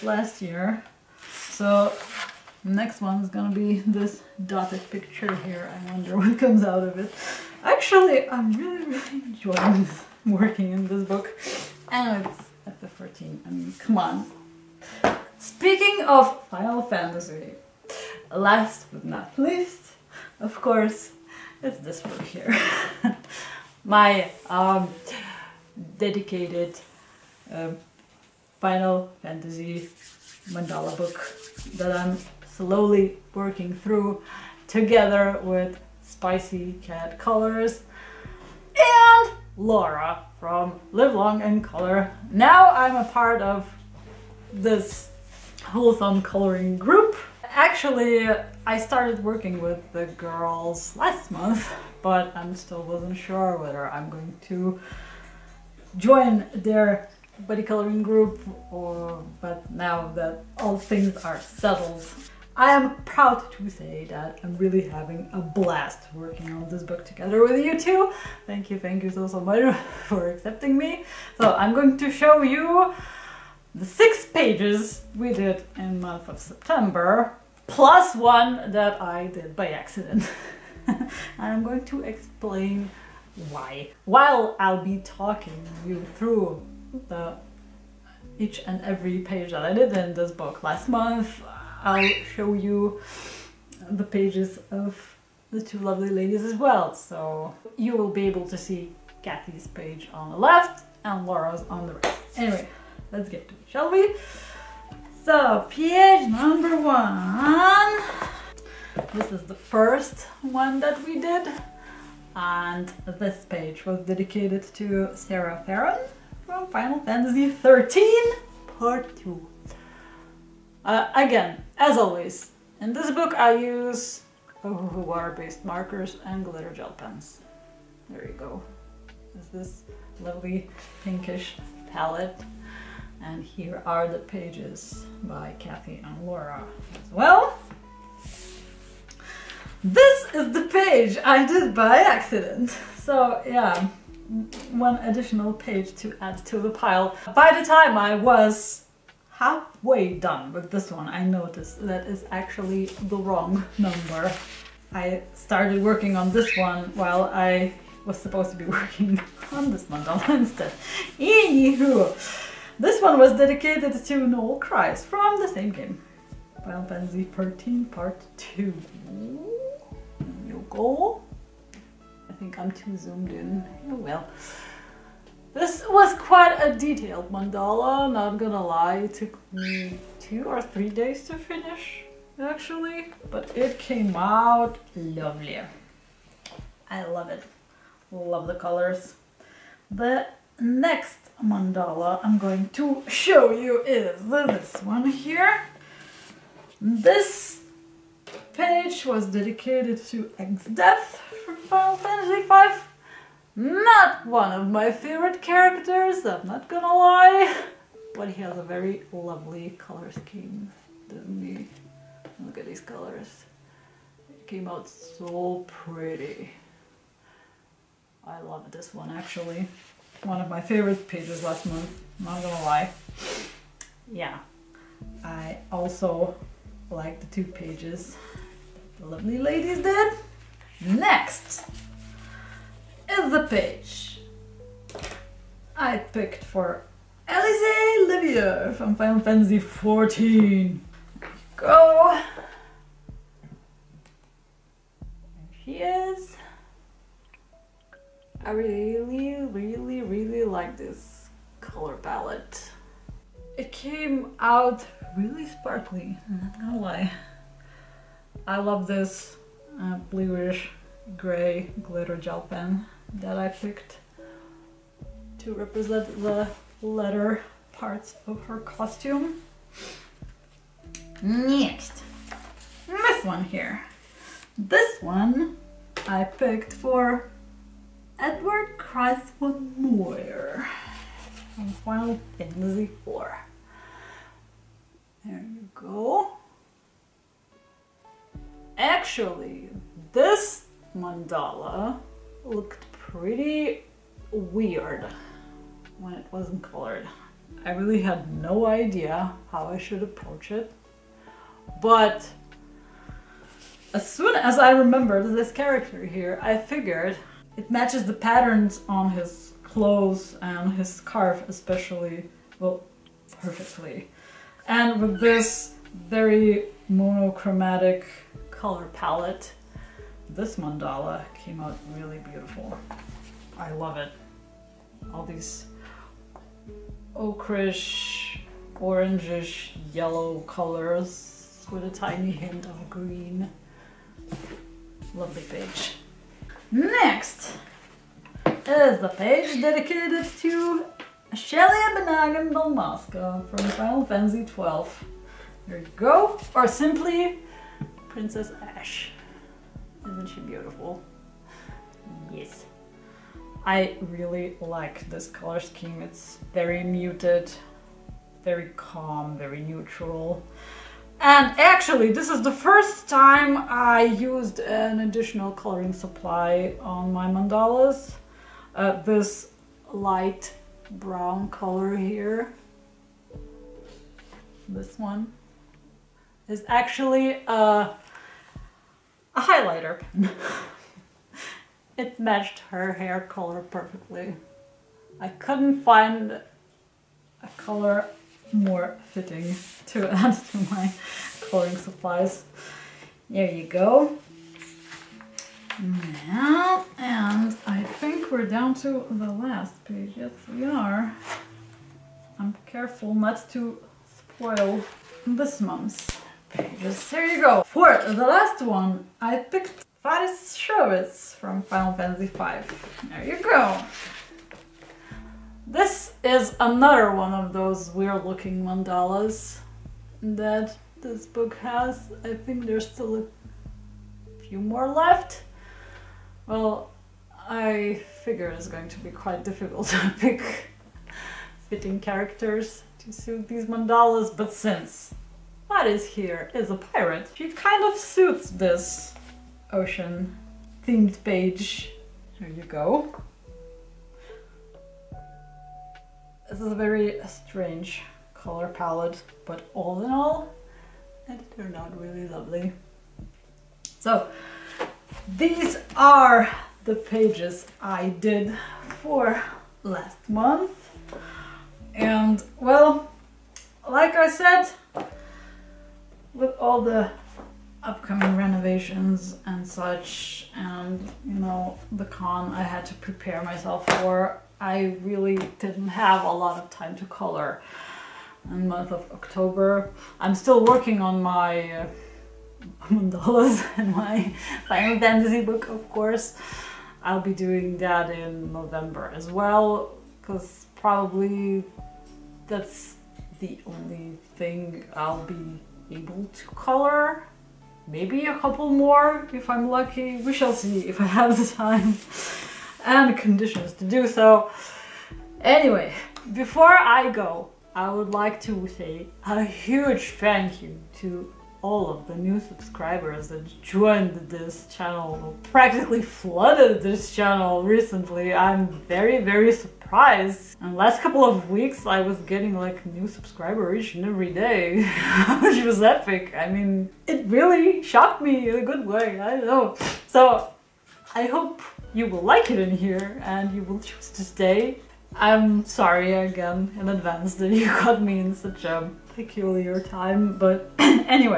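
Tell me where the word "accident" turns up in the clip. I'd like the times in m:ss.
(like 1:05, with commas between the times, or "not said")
1:19, 2:21.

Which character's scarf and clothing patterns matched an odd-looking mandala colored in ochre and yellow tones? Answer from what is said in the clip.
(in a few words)
Edward Chris von Muir.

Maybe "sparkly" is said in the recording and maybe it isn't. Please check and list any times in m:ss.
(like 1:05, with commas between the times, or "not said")
4:15.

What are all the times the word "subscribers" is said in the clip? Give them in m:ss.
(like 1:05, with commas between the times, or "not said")
8:32, 8:43.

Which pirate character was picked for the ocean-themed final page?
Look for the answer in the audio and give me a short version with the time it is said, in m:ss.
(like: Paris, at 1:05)
Faris Scherwiz, at 6:50.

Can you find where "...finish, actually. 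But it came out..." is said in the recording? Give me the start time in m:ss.
3:01.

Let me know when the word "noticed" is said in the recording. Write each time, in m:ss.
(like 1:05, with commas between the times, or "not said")
2:31.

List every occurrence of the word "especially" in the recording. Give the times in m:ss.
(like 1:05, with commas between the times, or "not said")
5:11.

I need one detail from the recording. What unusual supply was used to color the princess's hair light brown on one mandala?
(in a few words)
a highlighter.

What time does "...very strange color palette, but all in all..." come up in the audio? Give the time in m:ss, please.
7:26.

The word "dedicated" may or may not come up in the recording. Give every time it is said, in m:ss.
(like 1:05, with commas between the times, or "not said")
0:25, 1:54, 2:43, 3:19, 5:39.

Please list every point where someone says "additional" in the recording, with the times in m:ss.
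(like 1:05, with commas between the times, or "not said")
2:24, 6:05.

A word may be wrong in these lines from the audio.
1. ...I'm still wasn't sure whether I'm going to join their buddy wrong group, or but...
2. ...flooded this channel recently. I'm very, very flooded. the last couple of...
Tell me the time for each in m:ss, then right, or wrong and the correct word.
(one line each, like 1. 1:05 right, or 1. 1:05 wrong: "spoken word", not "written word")
1. 0:52 wrong: "coloring", not "wrong"
2. 8:36 wrong: "surprised", not "flooded".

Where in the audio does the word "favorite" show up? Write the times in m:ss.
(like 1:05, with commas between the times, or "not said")
3:24, 3:40.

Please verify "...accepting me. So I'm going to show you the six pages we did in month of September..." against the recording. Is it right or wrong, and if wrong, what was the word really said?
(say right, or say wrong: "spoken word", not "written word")
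right.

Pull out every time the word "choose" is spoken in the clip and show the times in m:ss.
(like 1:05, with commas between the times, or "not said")
8:53.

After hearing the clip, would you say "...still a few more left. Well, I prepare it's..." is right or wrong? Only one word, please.
wrong.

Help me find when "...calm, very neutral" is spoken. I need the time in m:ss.
5:58.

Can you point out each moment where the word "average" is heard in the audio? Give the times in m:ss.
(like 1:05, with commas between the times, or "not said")
not said.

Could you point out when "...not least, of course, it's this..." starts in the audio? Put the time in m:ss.
0:19.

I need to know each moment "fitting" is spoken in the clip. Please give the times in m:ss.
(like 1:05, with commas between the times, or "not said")
6:29, 7:11.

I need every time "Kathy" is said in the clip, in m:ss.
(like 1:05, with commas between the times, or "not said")
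1:39, 2:15.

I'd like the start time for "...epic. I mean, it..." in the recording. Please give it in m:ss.
8:45.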